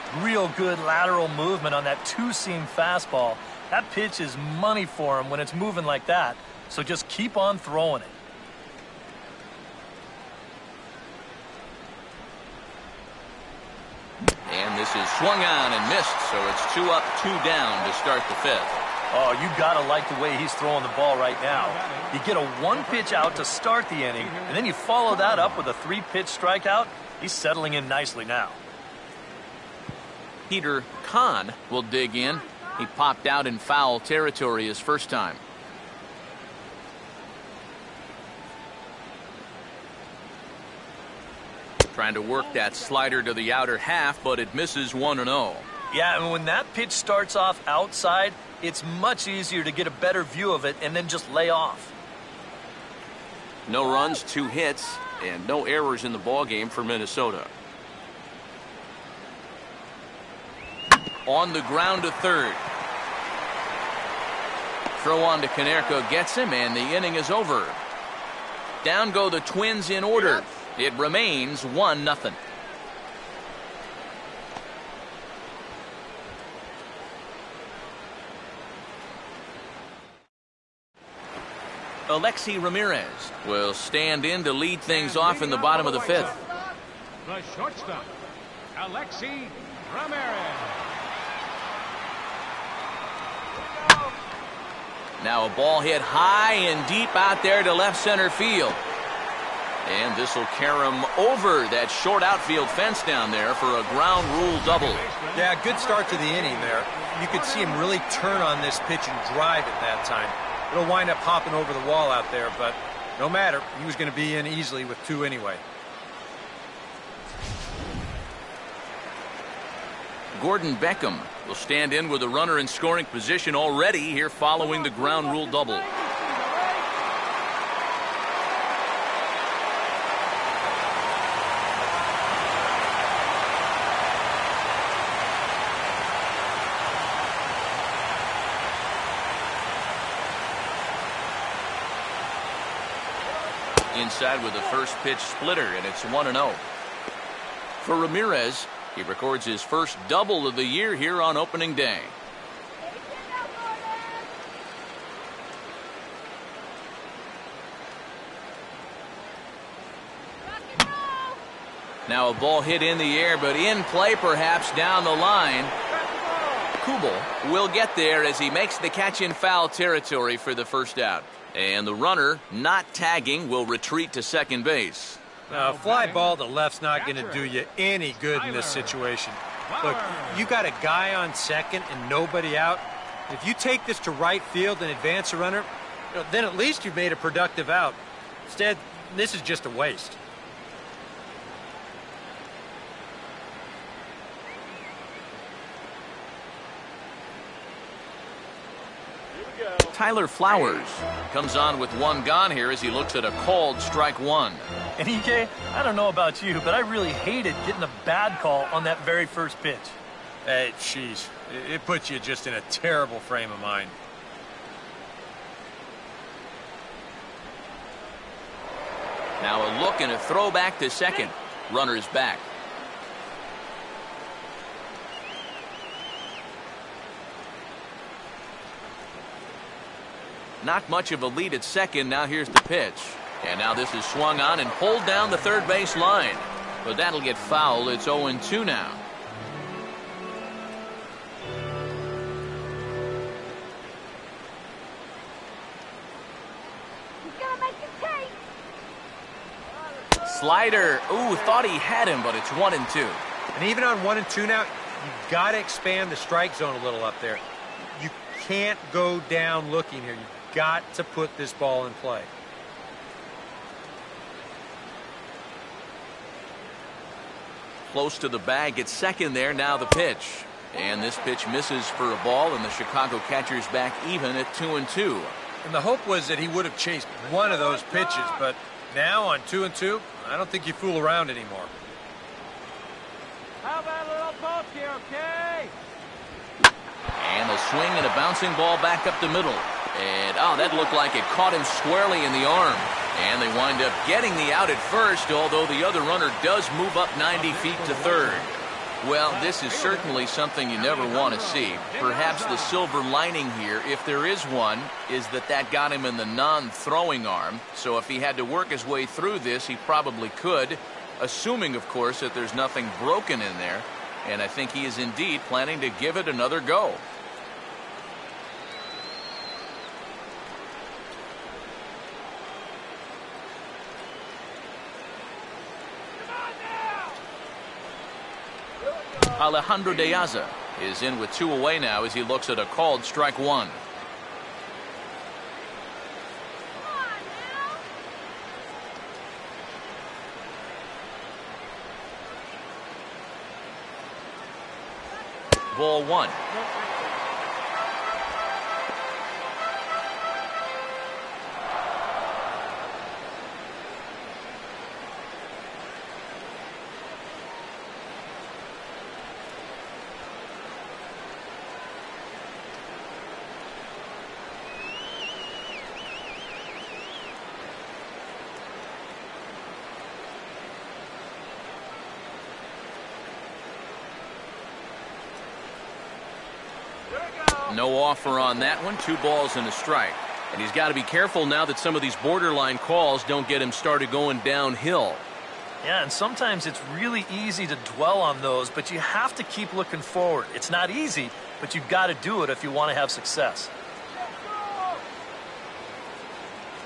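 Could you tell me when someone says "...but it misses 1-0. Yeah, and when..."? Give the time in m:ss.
0:44.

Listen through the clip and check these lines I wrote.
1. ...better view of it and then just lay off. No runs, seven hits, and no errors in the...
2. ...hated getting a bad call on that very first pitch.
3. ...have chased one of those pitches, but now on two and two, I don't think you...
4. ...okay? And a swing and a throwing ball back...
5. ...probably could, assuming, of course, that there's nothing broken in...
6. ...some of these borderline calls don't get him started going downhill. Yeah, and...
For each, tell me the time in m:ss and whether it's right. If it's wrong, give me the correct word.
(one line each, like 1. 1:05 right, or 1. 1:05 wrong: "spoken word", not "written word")
1. 0:49 wrong: "two", not "seven"
2. 3:27 right
3. 4:36 right
4. 4:45 wrong: "bouncing", not "throwing"
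5. 5:09 right
6. 6:21 right.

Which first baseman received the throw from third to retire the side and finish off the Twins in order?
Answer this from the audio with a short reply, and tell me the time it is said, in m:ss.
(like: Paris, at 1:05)
Konerko, at 1:05.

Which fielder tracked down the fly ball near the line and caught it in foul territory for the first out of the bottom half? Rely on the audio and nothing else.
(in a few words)
Kubel.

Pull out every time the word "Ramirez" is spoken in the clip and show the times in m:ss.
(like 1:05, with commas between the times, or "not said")
1:22, 1:29, 2:27.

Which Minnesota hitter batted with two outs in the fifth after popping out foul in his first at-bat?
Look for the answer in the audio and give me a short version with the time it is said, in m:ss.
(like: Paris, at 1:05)
Peter Kahn, at 0:30.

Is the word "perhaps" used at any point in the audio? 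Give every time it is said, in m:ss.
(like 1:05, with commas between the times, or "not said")
2:44, 5:01.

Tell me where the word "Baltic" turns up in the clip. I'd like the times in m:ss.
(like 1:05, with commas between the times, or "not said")
not said.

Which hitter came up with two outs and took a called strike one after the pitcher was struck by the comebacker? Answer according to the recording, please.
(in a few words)
Alejandro De Aza.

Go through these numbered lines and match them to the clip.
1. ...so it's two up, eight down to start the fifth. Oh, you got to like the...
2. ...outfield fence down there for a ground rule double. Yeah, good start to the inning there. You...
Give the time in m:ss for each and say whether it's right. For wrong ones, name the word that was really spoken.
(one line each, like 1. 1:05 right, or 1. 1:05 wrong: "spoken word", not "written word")
1. 0:16 wrong: "two", not "eight"
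2. 1:42 right.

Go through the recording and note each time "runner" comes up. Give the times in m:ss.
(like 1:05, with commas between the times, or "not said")
2:02, 2:51, 3:05, 3:41, 4:56.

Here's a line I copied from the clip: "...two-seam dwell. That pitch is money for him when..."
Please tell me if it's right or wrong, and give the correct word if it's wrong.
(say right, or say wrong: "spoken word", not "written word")
wrong: "fastball", not "dwell".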